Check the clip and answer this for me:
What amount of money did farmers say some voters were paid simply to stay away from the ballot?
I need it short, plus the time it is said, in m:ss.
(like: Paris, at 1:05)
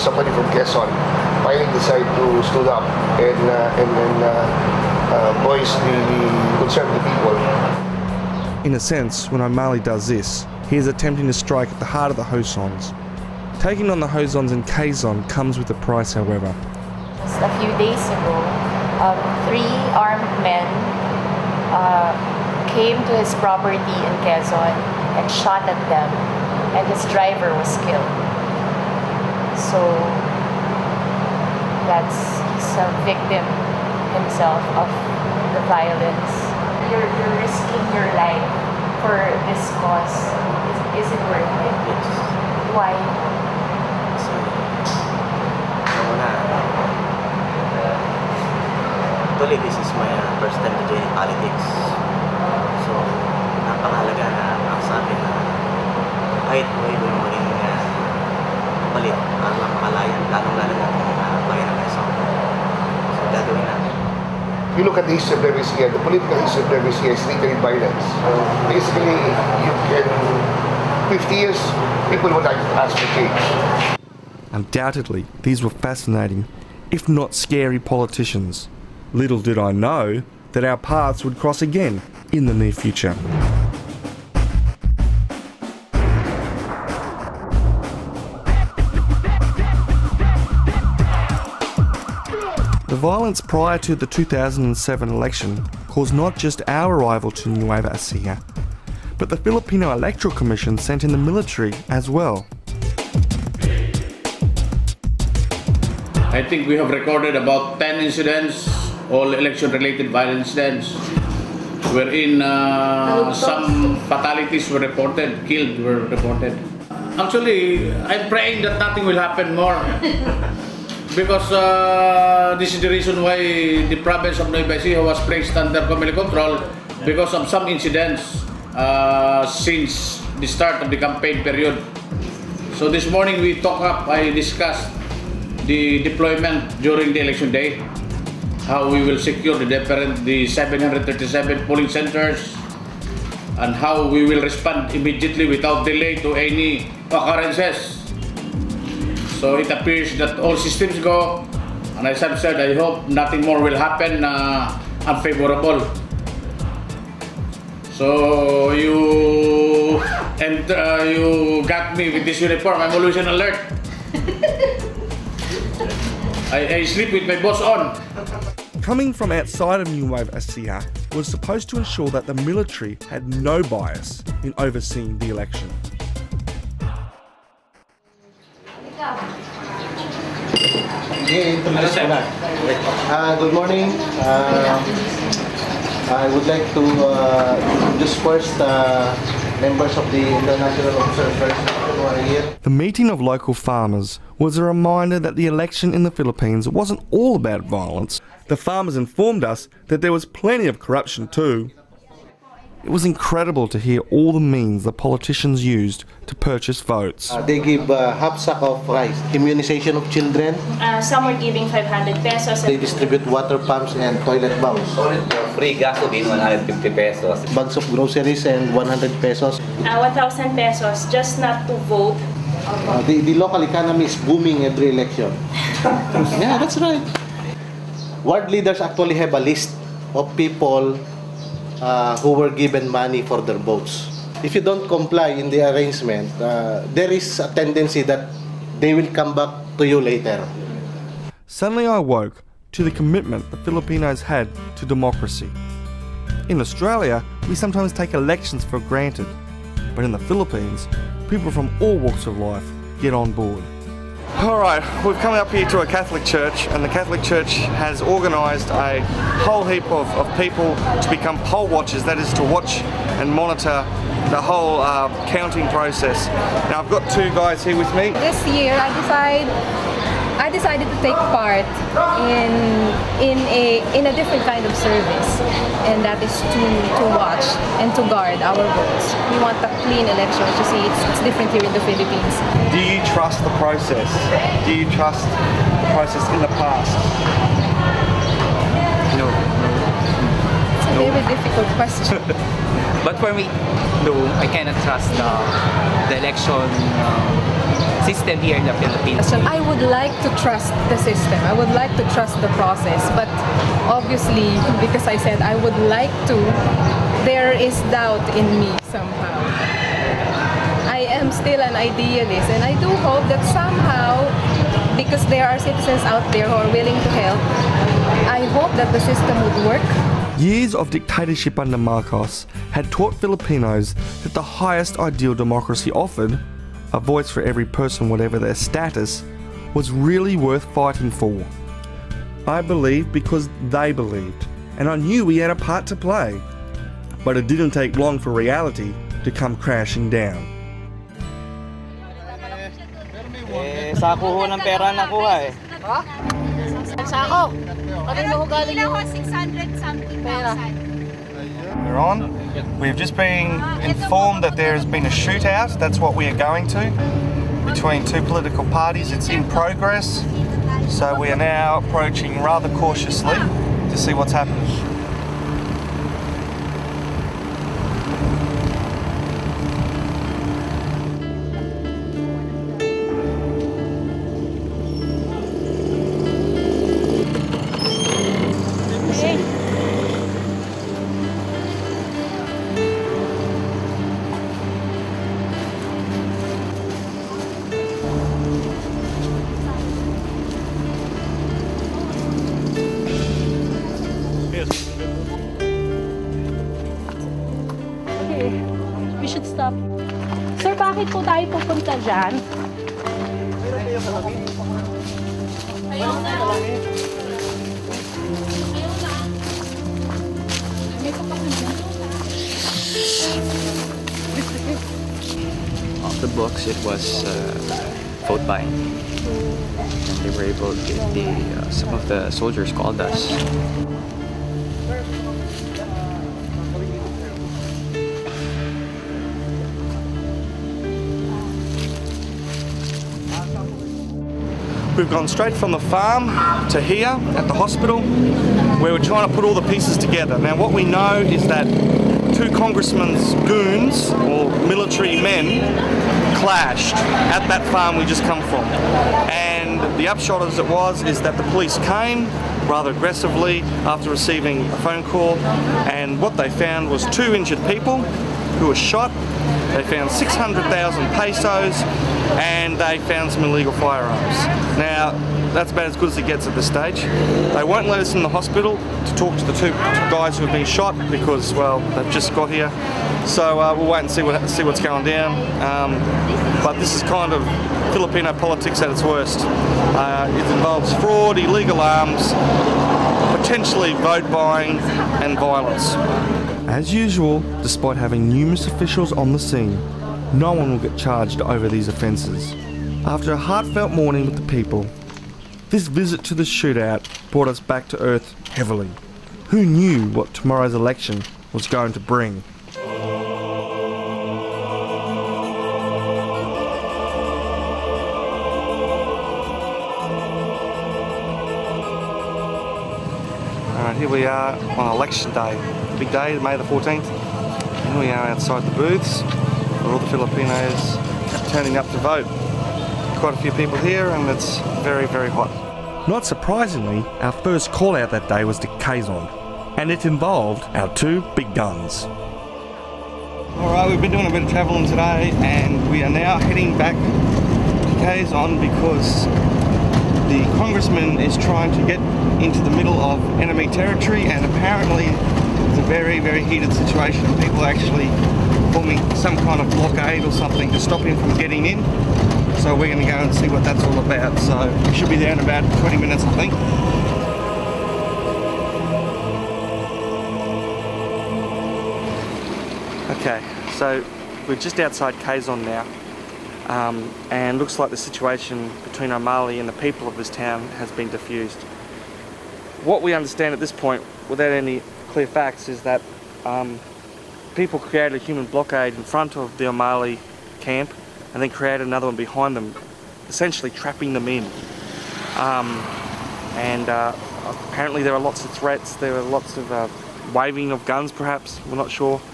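1,000 pesos, at 3:40.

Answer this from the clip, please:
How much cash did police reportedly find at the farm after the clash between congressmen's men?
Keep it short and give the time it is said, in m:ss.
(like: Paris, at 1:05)
600,000 pesos, at 7:40.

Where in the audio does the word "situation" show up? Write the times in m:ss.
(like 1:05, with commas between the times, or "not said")
9:06, 9:27.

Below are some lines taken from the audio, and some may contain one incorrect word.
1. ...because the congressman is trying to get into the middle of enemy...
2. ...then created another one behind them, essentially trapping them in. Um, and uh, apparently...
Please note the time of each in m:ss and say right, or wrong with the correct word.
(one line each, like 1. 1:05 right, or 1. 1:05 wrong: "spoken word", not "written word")
1. 8:58 right
2. 9:41 right.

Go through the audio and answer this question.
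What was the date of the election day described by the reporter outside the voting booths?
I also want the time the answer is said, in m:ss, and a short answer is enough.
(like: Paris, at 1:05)
May 14, at 8:36.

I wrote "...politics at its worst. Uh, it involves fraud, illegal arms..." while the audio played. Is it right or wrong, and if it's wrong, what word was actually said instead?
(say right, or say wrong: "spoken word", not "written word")
right.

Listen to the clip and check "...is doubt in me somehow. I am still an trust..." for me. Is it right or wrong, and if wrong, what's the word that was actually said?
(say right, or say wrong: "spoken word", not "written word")
wrong: "idealist", not "trust".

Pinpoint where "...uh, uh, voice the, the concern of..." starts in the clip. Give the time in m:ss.
0:04.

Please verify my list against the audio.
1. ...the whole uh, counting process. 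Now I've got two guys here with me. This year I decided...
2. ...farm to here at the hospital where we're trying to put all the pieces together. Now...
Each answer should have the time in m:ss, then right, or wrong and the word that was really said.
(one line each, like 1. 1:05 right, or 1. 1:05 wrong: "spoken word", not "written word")
1. 4:24 right
2. 7:15 right.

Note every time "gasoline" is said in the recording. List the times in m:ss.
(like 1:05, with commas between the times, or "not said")
3:35.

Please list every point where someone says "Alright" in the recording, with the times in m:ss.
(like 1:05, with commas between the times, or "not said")
4:14, 8:33, 8:53.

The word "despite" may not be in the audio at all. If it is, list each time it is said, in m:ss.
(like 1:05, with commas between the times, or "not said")
8:07.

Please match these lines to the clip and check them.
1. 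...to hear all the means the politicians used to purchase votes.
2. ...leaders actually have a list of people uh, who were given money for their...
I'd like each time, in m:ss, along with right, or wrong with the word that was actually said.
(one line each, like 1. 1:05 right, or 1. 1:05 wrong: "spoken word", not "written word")
1. 3:23 right
2. 3:48 right.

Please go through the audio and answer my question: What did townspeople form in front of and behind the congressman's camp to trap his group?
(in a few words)
human blockade.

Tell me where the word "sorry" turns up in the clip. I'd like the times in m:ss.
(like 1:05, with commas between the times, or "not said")
not said.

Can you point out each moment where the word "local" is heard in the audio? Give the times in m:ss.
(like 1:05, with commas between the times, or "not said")
3:13, 3:43.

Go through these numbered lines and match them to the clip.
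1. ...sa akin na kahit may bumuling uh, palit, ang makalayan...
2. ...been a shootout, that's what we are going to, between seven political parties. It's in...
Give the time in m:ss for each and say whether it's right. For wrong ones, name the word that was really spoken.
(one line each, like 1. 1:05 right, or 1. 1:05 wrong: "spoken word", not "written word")
1. 0:54 right
2. 5:54 wrong: "two", not "seven".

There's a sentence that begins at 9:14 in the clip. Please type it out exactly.
So we should be there in about 20 minutes, I think.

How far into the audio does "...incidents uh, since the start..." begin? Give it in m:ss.
2:07.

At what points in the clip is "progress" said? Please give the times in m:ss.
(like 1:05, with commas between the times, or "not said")
5:59.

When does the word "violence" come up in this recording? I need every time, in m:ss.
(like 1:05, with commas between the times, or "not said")
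0:35, 1:07, 1:33, 1:50, 3:17, 8:05.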